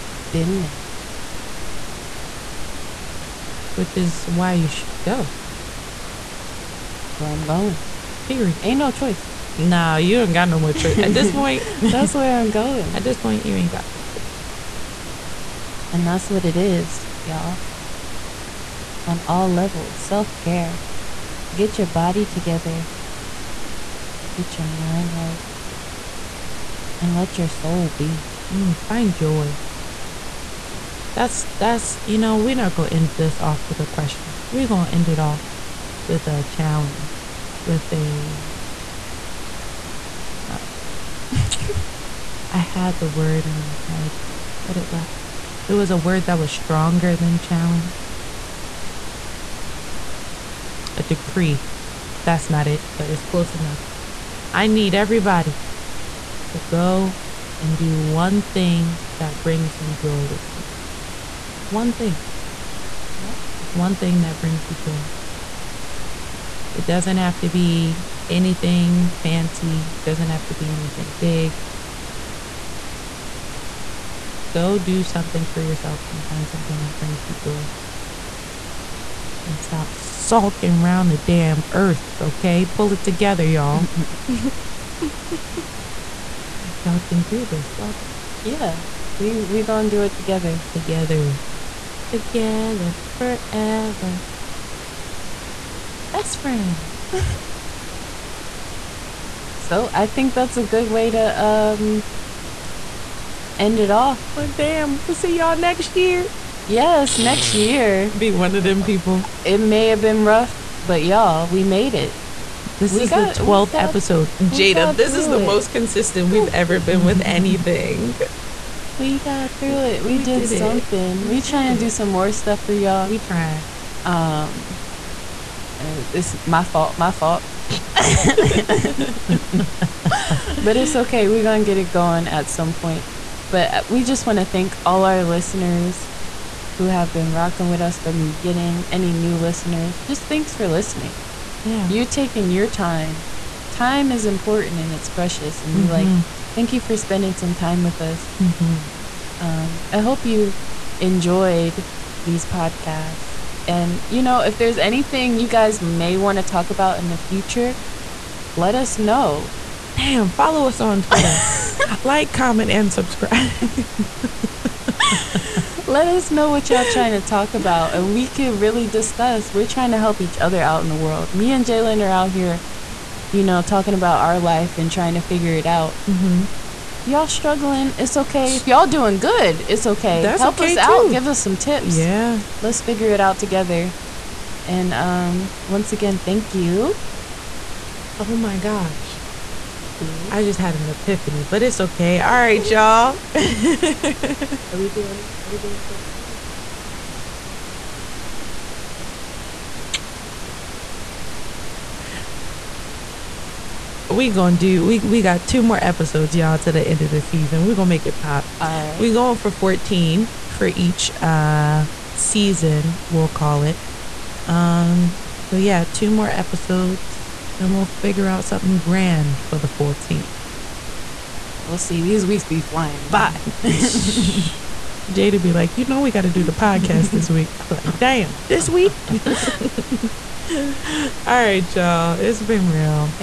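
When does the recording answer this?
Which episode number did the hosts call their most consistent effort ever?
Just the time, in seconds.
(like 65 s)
113 s.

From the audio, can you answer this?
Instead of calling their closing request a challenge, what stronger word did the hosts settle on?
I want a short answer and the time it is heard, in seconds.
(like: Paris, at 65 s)
A decree, at 50 s.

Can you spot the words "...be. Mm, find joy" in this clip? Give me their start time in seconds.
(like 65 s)
27 s.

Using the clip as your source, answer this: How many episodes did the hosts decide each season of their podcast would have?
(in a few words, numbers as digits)
14.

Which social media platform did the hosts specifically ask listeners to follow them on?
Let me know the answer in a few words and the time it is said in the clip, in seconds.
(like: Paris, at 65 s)
Twitter, at 161 s.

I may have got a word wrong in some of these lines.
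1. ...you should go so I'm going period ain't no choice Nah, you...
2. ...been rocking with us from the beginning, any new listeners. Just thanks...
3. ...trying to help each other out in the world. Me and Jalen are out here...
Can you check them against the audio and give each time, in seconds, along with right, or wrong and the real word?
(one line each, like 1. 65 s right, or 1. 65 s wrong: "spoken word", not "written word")
1. 4 s right
2. 137 s right
3. 169 s right.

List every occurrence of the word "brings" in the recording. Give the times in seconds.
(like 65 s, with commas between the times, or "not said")
59 s, 64 s, 76 s.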